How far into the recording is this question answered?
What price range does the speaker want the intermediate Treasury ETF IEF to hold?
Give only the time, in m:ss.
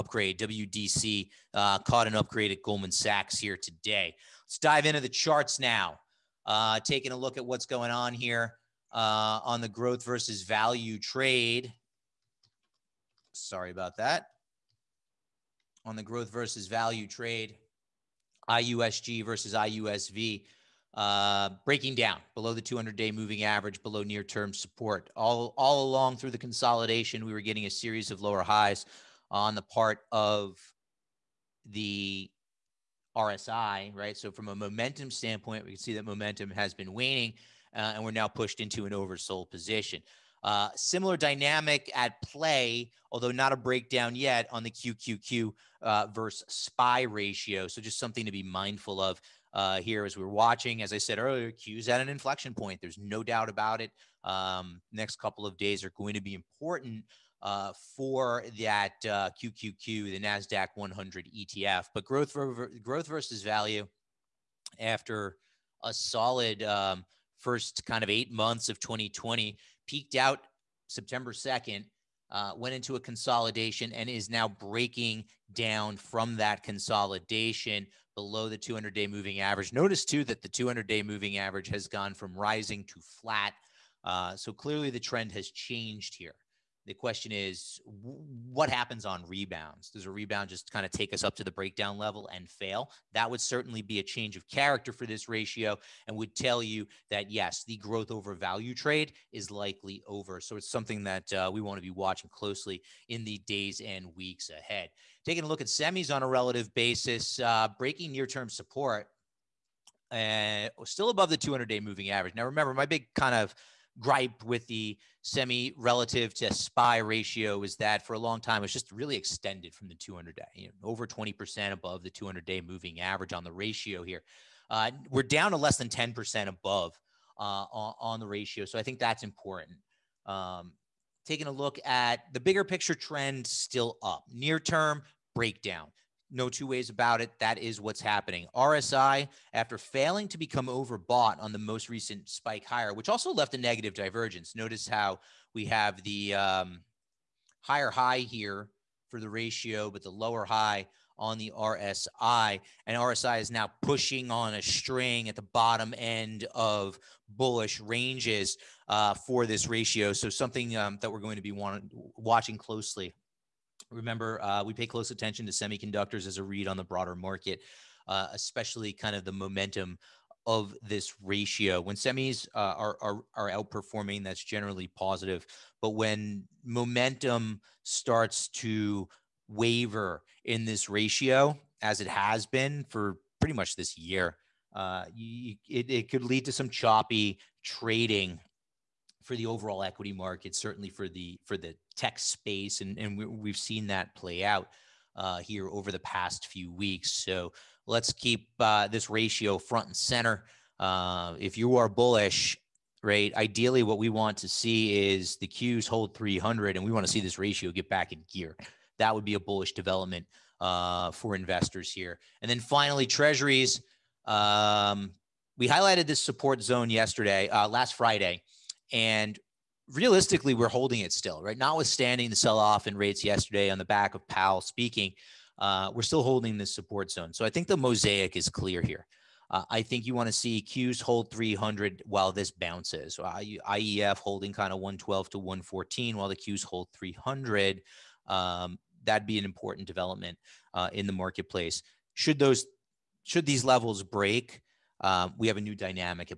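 3:54.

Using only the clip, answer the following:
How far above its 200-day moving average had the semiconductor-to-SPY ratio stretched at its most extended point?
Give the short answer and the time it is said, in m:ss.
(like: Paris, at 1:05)
over 20%, at 2:00.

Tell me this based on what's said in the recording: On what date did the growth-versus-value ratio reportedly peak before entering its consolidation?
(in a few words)
September 2.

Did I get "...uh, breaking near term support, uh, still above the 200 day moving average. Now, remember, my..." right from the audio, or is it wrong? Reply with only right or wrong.
right.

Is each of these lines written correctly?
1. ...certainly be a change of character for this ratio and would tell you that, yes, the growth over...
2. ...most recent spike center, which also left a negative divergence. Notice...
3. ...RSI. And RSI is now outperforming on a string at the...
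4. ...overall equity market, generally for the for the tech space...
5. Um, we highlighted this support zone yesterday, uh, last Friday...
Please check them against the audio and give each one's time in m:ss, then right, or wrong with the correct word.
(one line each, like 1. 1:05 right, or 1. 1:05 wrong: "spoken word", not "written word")
1. 1:33 right
2. 2:21 wrong: "higher", not "center"
3. 2:31 wrong: "pushing", not "outperforming"
4. 3:09 wrong: "certainly", not "generally"
5. 3:34 right.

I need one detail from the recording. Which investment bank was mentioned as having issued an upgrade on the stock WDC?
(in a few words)
Goldman Sachs.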